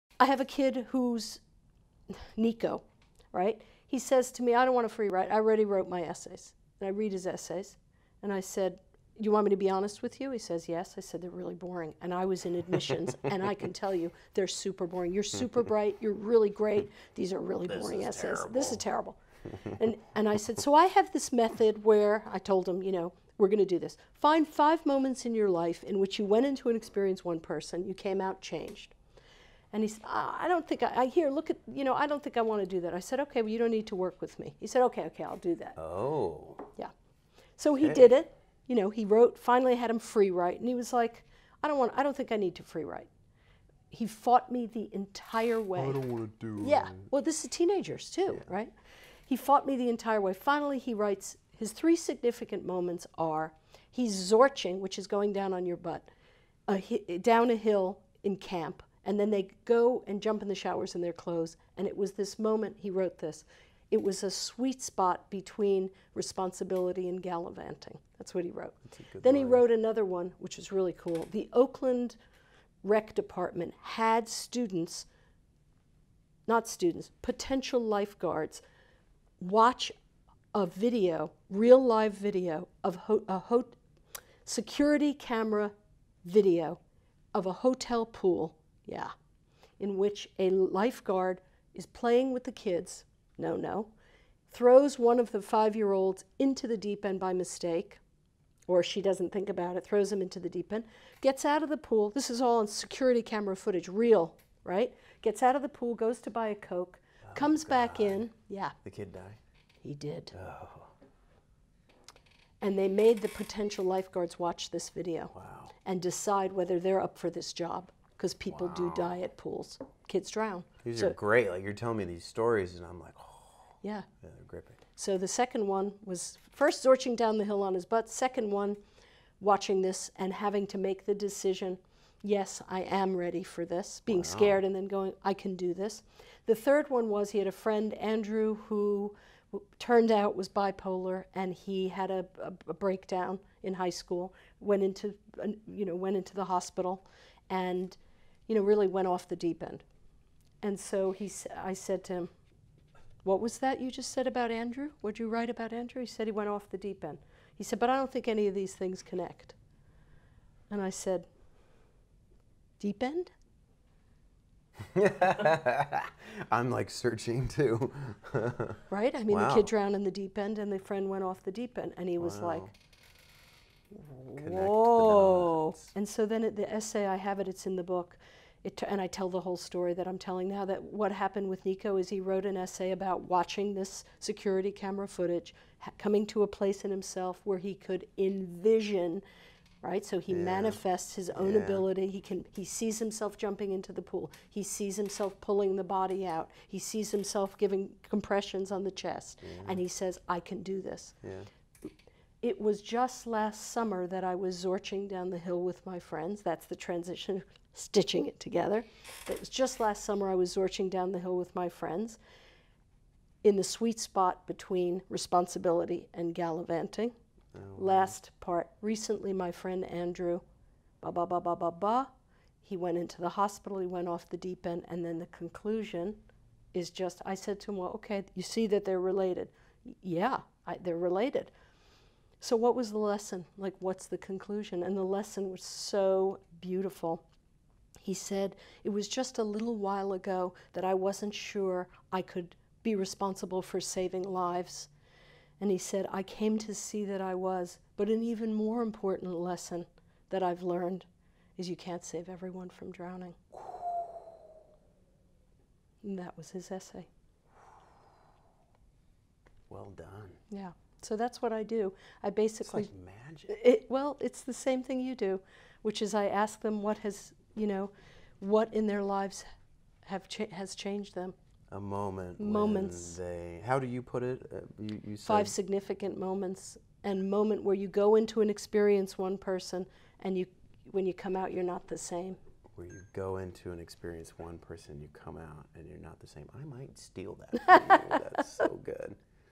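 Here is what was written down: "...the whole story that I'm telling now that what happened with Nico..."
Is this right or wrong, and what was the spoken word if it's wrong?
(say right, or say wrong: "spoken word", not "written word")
right.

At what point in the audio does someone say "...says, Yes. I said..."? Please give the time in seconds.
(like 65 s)
10 s.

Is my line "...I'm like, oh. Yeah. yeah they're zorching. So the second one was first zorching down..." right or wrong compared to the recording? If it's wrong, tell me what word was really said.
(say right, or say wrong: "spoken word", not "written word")
wrong: "gripping", not "zorching".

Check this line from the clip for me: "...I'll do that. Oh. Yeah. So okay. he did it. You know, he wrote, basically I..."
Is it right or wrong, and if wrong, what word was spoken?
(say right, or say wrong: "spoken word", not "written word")
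wrong: "finally", not "basically".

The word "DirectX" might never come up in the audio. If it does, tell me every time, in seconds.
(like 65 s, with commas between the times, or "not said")
not said.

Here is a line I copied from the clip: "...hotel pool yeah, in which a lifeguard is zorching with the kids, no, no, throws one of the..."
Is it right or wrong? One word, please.
wrong.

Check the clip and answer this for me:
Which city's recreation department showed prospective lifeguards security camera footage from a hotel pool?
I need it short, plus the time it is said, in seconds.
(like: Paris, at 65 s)
Oakland, at 71 s.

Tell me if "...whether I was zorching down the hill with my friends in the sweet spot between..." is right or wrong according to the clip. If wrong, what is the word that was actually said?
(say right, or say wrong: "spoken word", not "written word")
wrong: "summer", not "whether".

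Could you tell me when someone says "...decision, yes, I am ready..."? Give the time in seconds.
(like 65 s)
131 s.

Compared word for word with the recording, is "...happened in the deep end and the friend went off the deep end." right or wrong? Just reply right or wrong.
wrong.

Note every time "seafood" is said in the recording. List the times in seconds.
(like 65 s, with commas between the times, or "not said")
not said.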